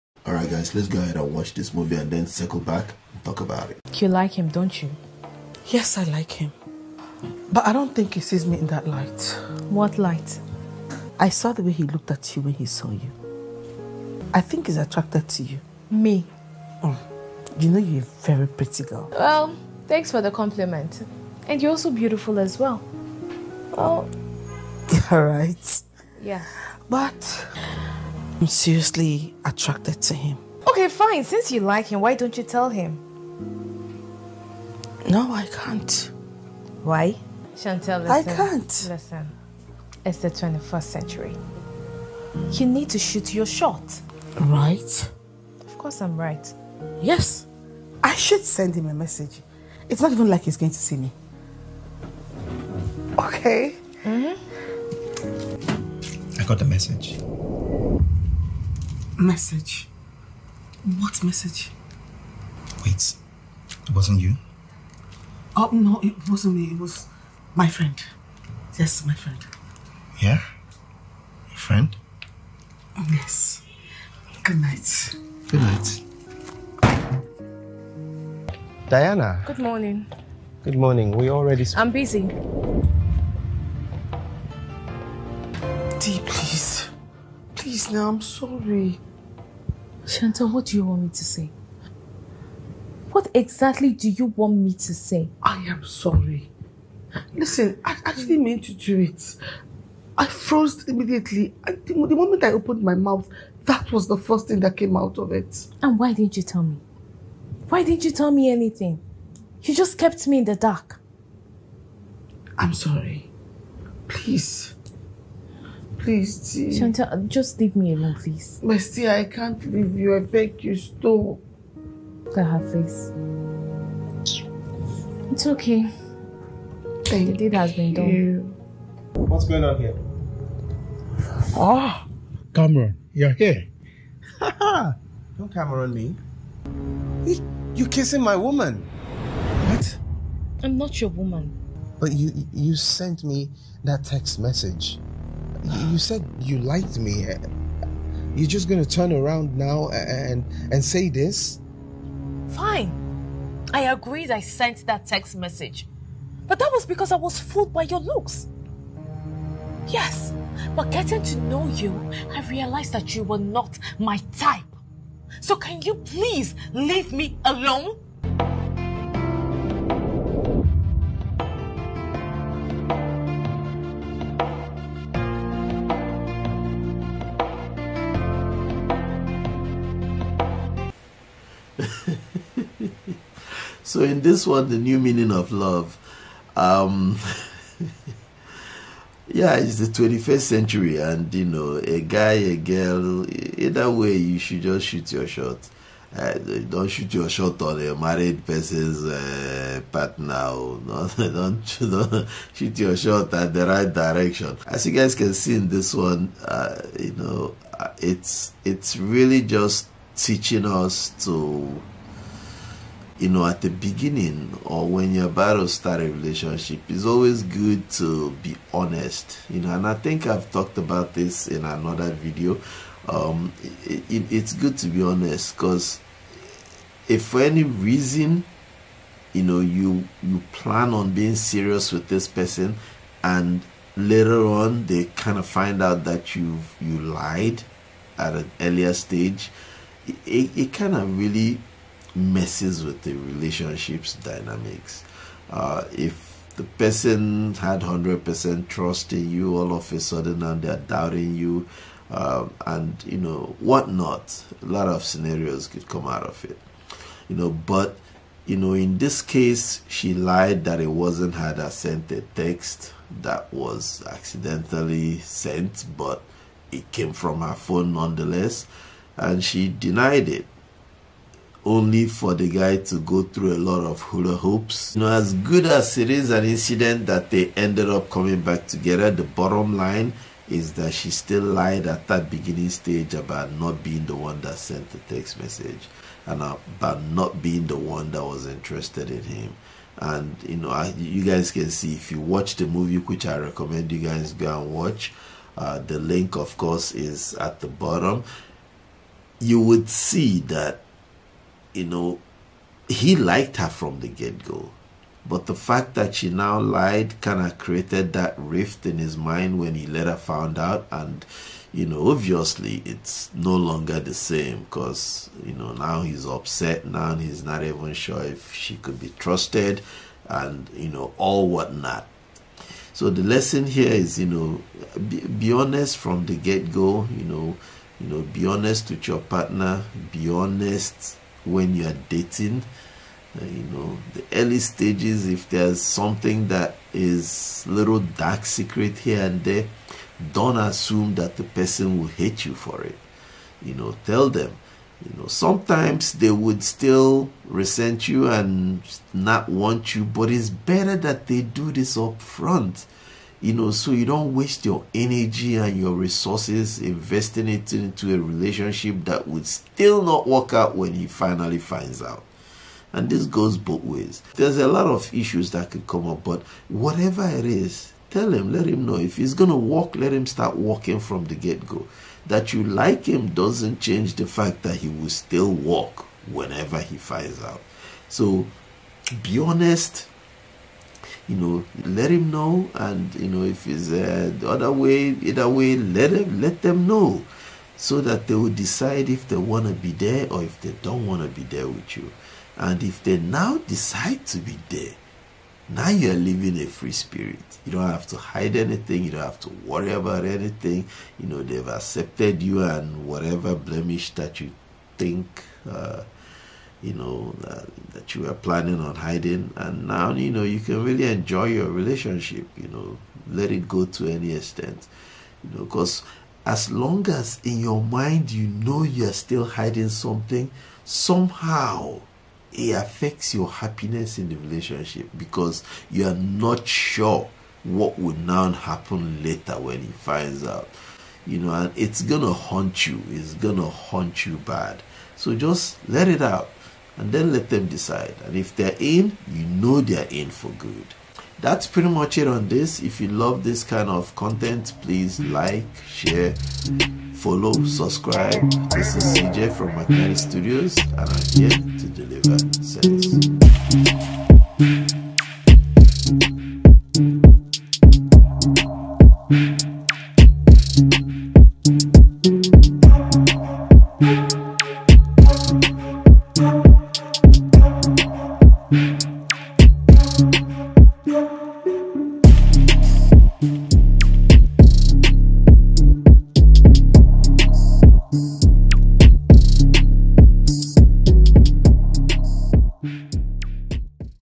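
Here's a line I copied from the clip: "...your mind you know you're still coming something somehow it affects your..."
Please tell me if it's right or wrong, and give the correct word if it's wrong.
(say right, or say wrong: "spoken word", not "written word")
wrong: "hiding", not "coming".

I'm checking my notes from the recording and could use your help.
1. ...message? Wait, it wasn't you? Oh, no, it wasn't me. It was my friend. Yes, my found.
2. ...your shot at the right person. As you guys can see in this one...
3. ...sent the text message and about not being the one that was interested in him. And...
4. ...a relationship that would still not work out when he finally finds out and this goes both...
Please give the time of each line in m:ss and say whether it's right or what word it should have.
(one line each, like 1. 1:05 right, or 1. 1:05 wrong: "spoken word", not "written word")
1. 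1:01 wrong: "friend", not "found"
2. 3:22 wrong: "direction", not "person"
3. 4:44 right
4. 5:58 right.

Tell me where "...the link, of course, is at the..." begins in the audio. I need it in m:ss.
4:55.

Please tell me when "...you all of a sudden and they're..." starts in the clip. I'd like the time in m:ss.
4:09.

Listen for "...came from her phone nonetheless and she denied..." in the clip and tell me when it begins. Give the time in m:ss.
4:26.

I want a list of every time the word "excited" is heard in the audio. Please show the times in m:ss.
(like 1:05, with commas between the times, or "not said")
not said.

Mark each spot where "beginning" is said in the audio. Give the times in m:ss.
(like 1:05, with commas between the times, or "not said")
3:33, 4:42.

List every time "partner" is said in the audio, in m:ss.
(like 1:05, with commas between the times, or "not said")
3:19, 5:29.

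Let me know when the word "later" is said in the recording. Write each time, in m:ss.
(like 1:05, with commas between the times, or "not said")
3:53, 5:09, 7:09.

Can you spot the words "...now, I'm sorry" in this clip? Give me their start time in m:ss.
1:27.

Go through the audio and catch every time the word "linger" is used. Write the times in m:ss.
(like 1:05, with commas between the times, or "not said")
not said.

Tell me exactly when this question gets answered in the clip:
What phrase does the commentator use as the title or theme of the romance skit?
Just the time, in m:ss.
3:04.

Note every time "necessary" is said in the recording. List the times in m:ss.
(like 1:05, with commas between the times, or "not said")
not said.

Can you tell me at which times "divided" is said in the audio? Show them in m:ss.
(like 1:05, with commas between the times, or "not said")
not said.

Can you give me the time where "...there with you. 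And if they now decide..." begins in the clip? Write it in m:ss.
6:31.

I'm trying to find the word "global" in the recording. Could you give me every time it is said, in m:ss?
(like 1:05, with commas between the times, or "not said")
not said.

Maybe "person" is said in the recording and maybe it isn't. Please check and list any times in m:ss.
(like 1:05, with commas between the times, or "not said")
3:18, 3:52, 4:06, 5:41.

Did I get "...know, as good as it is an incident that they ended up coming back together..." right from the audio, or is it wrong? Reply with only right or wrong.
right.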